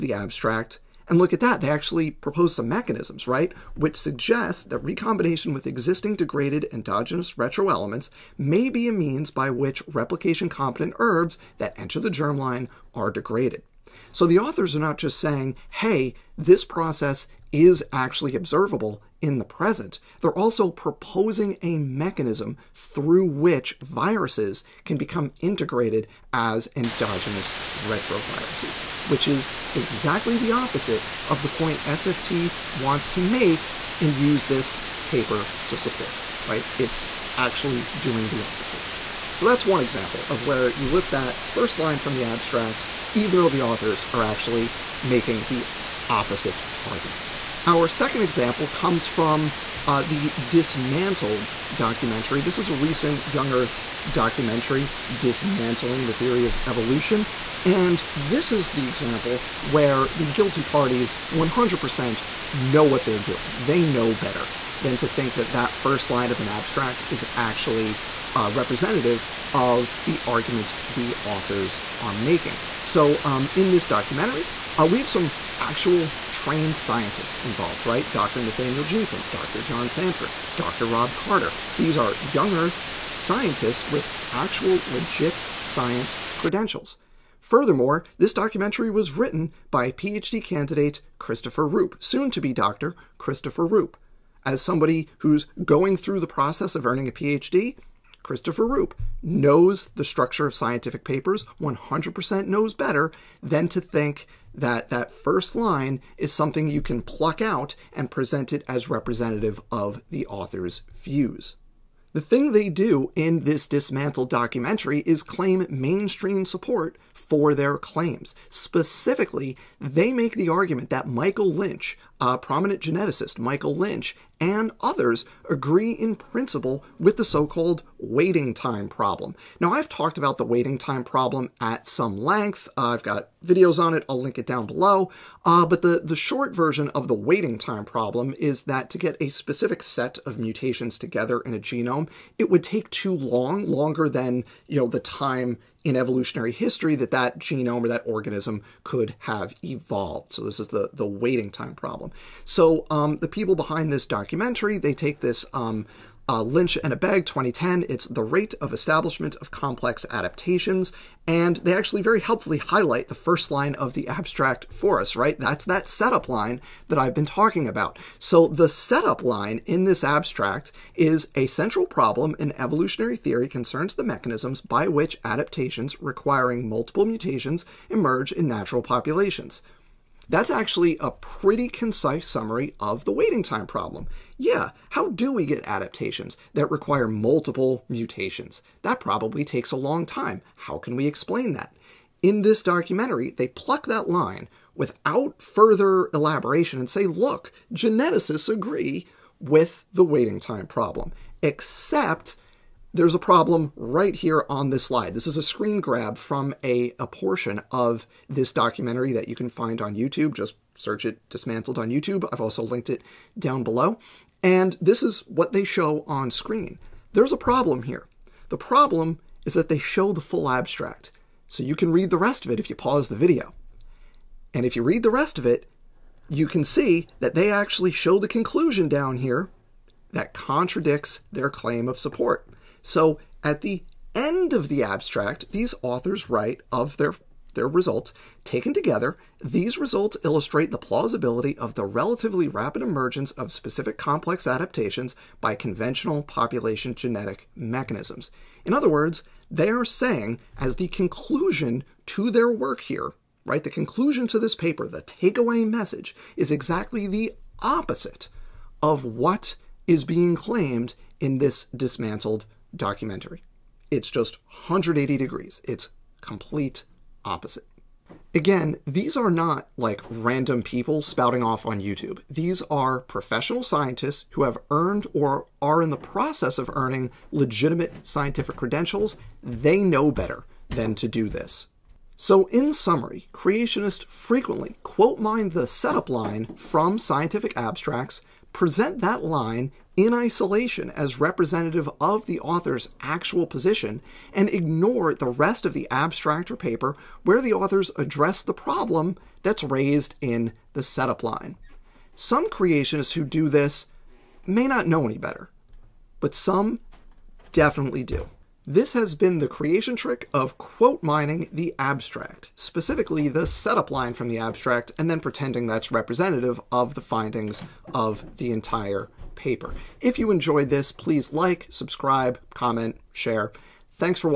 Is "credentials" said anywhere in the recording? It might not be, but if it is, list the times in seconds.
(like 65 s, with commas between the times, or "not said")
86 s, 278 s.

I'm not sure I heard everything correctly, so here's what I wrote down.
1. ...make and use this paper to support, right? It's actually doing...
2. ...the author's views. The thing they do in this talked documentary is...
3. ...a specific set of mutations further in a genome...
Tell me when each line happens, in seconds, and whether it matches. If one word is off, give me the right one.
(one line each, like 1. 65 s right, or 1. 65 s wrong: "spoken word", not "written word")
1. 33 s right
2. 110 s wrong: "dismantled", not "talked"
3. 139 s wrong: "together", not "further".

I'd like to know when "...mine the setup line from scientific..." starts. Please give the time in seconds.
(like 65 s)
285 s.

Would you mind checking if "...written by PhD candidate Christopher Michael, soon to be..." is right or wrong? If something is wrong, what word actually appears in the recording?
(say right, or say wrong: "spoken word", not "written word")
wrong: "Rupe", not "Michael".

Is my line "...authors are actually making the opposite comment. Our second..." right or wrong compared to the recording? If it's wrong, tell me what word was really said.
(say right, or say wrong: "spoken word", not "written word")
wrong: "argument", not "comment".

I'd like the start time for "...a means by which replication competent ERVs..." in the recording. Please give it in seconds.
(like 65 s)
8 s.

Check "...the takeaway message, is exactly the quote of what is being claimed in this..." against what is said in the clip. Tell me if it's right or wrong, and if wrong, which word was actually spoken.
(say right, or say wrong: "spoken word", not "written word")
wrong: "opposite", not "quote".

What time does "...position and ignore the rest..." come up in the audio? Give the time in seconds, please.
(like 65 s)
293 s.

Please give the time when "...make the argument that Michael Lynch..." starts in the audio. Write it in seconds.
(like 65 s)
120 s.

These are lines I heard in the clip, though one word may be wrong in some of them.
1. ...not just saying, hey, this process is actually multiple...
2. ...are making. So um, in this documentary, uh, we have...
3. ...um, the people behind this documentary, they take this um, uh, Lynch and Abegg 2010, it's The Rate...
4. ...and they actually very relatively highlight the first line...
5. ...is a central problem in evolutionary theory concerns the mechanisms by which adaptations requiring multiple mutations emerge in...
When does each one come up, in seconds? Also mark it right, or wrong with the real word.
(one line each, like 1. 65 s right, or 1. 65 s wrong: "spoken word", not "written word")
1. 14 s wrong: "observable", not "multiple"
2. 71 s right
3. 152 s right
4. 161 s wrong: "helpfully", not "relatively"
5. 170 s right.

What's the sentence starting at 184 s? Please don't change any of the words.
Yeah, how do we get adaptations that require multiple mutations?